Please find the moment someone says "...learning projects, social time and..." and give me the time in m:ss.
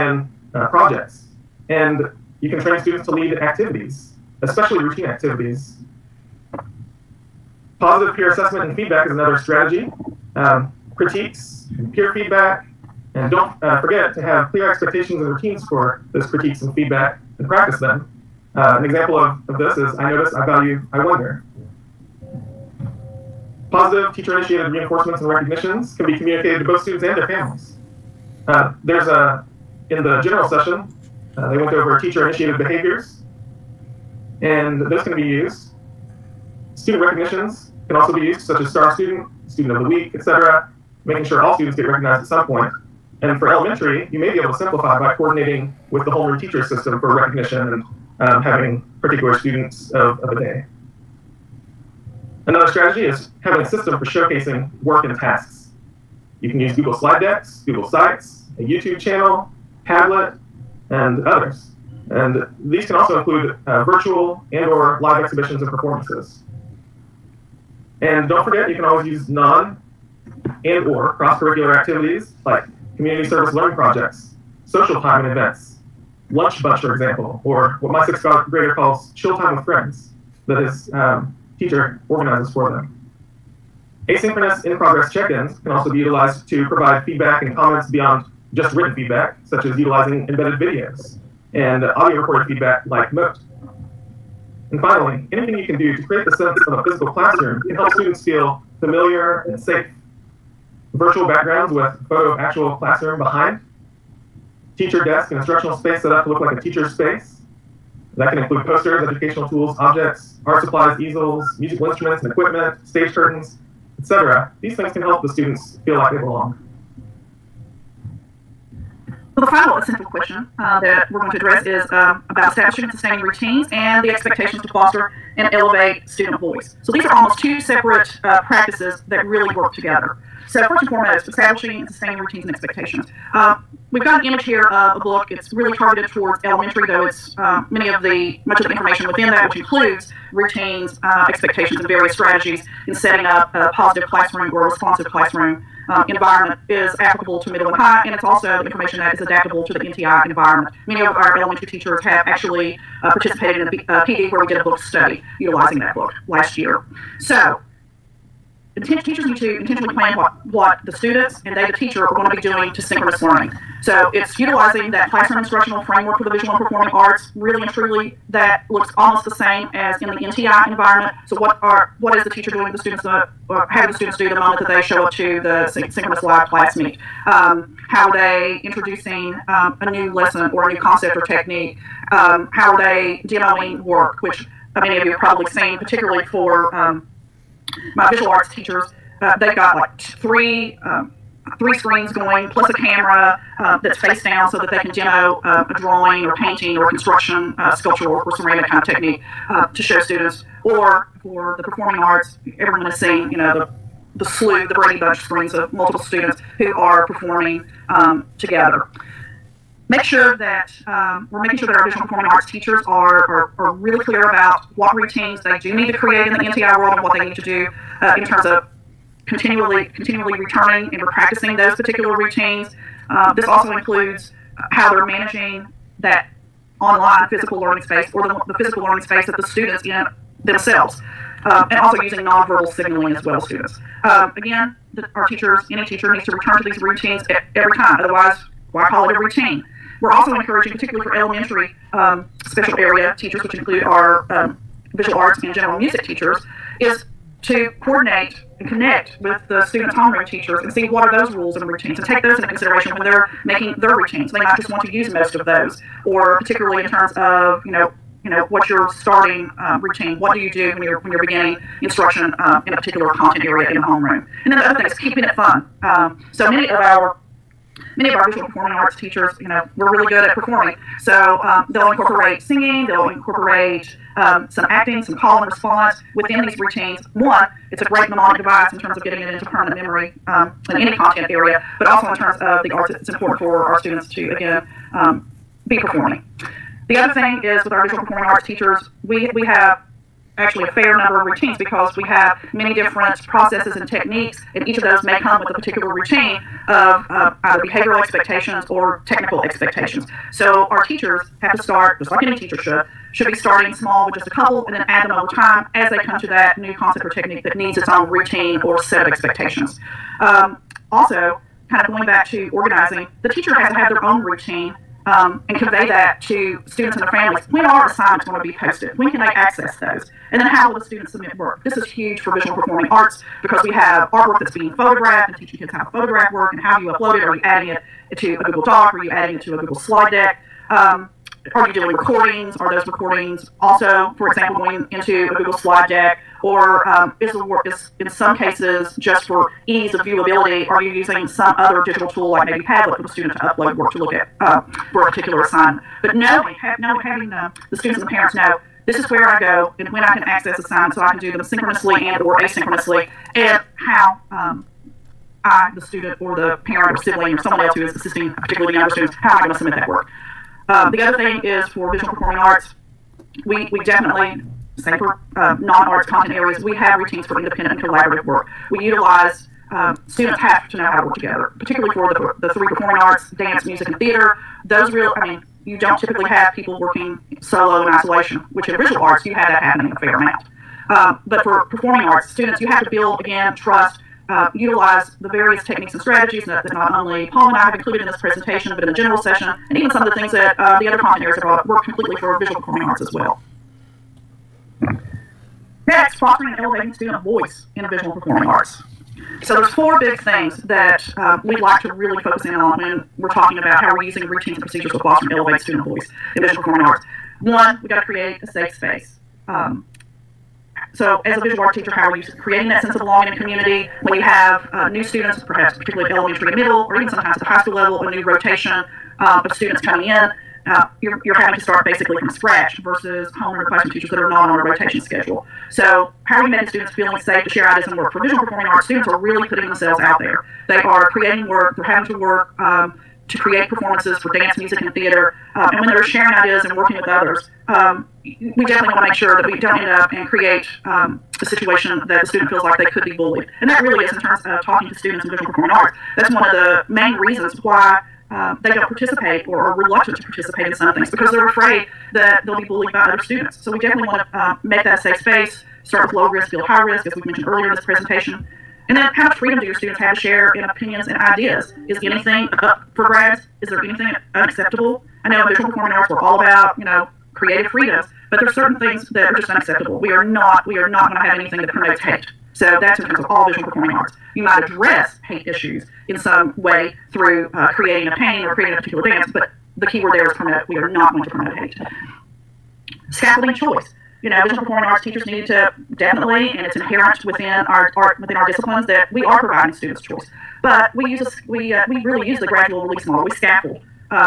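1:13.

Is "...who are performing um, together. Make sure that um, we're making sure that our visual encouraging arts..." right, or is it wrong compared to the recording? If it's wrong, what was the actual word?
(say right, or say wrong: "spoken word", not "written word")
wrong: "performing", not "encouraging".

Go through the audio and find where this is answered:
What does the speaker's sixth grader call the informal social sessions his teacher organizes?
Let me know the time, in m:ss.
1:19.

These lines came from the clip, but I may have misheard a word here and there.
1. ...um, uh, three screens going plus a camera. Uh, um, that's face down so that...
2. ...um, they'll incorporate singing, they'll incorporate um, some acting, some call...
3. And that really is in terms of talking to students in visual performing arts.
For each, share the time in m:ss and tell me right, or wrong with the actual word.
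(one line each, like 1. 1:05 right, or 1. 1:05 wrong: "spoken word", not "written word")
1. 3:10 right
2. 4:31 right
3. 7:23 right.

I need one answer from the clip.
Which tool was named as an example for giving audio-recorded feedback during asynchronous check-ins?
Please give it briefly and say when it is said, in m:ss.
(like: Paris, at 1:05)
Mote, at 1:33.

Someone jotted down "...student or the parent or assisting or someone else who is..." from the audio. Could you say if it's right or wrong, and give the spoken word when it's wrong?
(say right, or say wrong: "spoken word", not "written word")
wrong: "sibling", not "assisting".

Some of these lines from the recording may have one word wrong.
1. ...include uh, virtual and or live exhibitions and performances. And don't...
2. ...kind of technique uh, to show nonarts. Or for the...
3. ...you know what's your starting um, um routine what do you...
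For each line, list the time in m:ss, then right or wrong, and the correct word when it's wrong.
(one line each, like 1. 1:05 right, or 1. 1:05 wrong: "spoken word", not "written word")
1. 1:03 right
2. 3:18 wrong: "students", not "nonarts"
3. 4:18 right.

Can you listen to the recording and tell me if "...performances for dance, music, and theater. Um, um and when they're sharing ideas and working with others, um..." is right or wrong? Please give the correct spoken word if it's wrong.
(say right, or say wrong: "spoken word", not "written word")
right.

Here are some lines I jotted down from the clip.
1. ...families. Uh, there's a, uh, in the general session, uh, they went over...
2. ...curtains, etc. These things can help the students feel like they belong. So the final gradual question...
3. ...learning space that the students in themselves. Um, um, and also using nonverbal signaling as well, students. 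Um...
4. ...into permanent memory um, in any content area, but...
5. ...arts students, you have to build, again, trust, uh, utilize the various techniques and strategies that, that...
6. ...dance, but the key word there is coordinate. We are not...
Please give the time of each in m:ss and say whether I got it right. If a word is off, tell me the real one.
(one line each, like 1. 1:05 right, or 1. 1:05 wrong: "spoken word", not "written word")
1. 0:27 right
2. 1:53 wrong: "essential", not "gradual"
3. 3:48 right
4. 4:39 right
5. 6:22 right
6. 7:59 wrong: "promote", not "coordinate".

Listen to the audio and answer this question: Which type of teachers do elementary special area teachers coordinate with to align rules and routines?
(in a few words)
homeroom teachers.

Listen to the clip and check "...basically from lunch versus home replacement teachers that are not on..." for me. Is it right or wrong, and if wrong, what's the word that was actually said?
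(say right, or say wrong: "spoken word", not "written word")
wrong: "scratch", not "lunch".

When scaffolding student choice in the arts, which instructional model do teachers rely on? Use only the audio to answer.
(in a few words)
gradual release model.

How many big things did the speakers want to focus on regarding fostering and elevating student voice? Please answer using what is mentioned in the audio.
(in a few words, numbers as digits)
4.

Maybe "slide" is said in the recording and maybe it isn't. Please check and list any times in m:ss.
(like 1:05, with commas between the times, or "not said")
0:56, 5:29, 5:35.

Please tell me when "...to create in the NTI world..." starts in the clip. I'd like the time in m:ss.
3:35.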